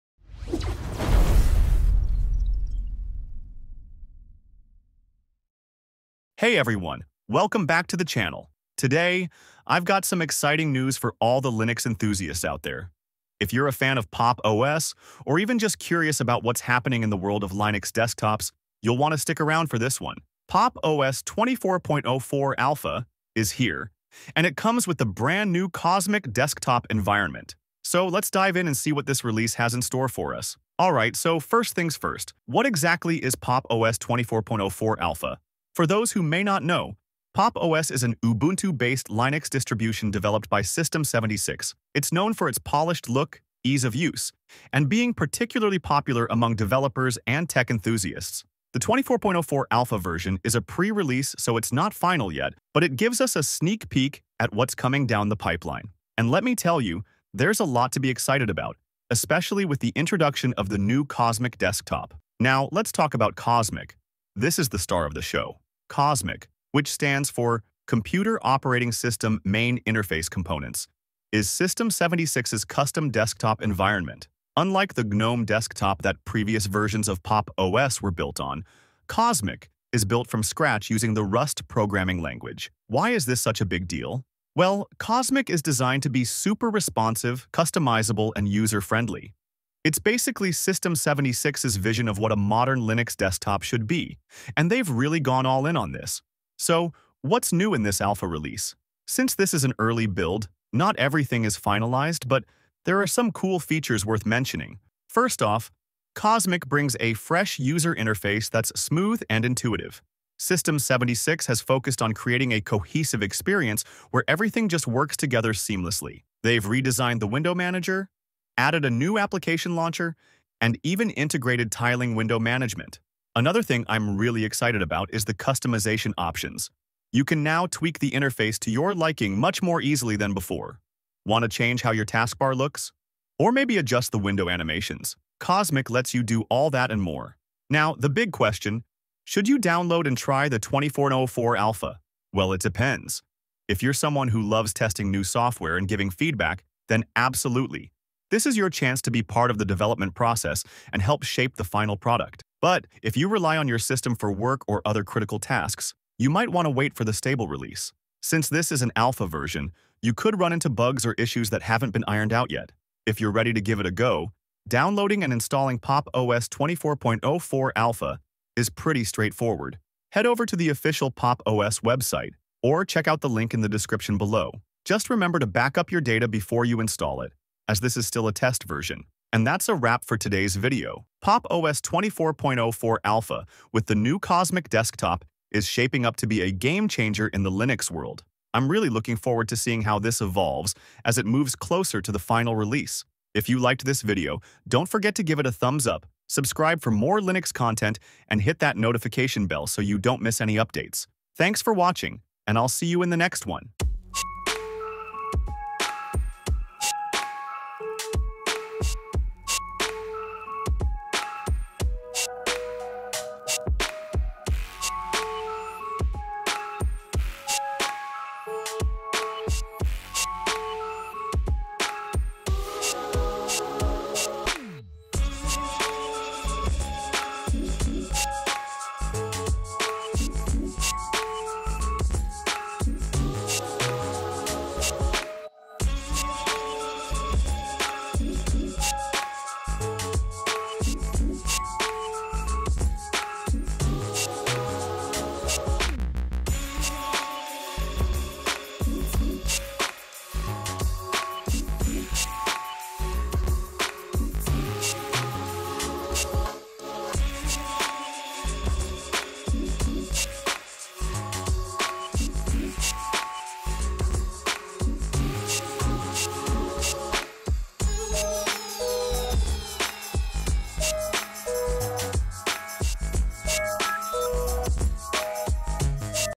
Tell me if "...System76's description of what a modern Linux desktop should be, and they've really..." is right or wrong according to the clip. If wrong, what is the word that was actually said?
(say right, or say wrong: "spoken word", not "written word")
wrong: "vision", not "description".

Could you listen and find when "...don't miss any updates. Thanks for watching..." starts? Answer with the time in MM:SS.
03:19.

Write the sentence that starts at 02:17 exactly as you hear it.
Now, the big question, should you download and try the 2404 Alpha?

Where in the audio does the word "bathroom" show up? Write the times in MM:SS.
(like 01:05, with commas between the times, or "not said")
not said.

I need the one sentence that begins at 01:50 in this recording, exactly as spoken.
System76 has focused on creating a cohesive experience where everything just works together seamlessly.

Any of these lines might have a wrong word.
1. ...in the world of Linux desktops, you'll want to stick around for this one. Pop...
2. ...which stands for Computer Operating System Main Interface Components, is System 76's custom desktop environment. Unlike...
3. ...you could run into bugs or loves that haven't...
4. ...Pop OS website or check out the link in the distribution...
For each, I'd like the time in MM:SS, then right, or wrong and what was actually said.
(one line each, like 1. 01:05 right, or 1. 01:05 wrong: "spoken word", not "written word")
1. 00:17 right
2. 01:06 right
3. 02:40 wrong: "issues", not "loves"
4. 02:51 wrong: "description", not "distribution".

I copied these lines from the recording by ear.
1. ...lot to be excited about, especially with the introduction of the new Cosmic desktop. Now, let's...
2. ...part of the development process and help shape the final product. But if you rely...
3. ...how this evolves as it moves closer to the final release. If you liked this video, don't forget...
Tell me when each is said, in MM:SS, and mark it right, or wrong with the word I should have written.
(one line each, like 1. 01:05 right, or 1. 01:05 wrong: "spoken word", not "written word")
1. 00:57 right
2. 02:29 right
3. 03:09 right.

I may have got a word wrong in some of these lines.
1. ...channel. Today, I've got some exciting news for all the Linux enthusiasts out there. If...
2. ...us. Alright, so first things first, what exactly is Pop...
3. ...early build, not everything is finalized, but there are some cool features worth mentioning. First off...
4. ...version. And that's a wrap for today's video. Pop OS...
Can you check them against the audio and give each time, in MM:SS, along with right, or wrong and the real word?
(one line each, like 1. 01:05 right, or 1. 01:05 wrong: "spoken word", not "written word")
1. 00:08 right
2. 00:30 right
3. 01:39 right
4. 02:58 right.